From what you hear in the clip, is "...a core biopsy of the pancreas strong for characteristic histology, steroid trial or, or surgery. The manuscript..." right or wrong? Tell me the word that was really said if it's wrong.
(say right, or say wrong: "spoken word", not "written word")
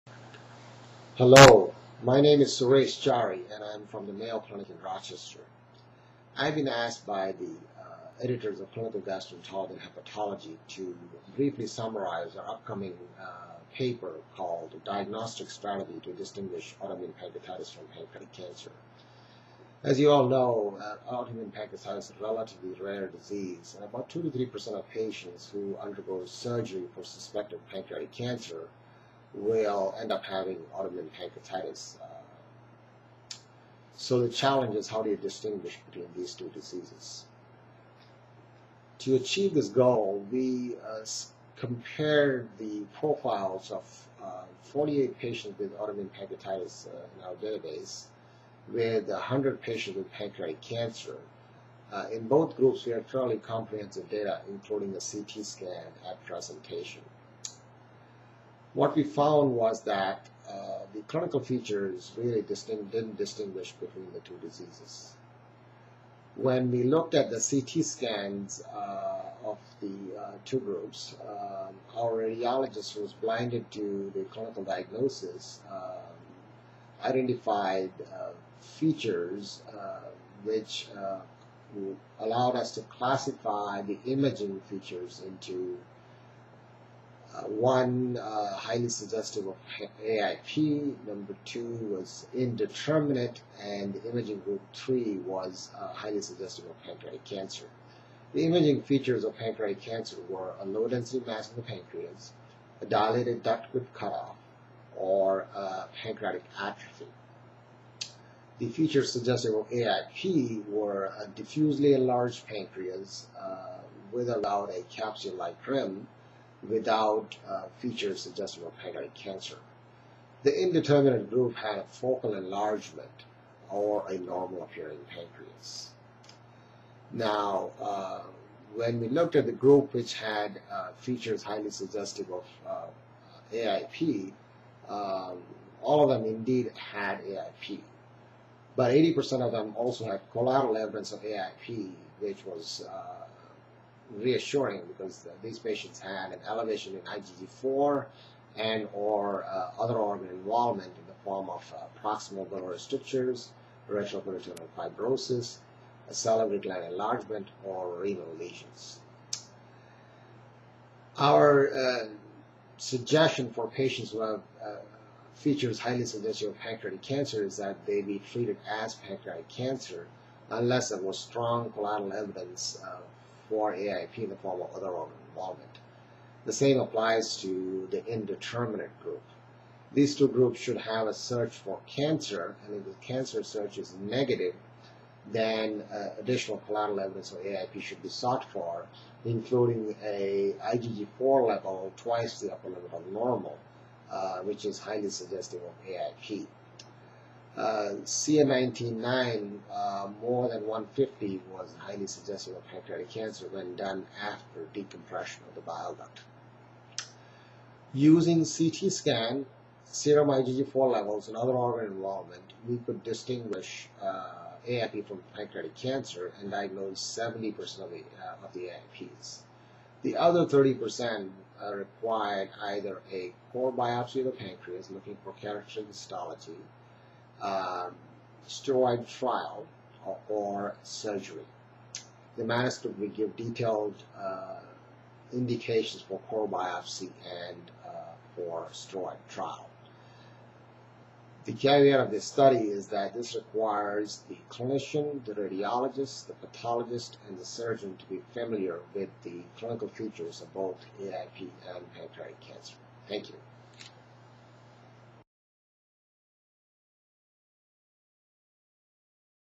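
wrong: "looking", not "strong".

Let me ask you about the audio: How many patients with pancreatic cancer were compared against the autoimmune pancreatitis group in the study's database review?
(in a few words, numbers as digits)
100.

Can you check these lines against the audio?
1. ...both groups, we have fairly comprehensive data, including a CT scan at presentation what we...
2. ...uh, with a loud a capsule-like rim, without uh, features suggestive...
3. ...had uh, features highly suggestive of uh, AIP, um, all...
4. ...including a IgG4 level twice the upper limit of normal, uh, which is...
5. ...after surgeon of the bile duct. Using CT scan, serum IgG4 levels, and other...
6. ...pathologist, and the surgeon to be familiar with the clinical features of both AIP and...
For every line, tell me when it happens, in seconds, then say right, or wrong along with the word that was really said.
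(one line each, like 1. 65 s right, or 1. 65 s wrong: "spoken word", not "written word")
1. 52 s right
2. 113 s right
3. 130 s right
4. 189 s right
5. 204 s wrong: "decompression", not "surgeon"
6. 246 s right.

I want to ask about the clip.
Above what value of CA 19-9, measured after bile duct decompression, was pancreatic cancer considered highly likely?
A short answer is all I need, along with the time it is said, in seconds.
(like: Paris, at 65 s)
150, at 200 s.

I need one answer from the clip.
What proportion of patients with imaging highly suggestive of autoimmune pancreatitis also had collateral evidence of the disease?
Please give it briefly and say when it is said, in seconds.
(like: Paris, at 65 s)
80%, at 138 s.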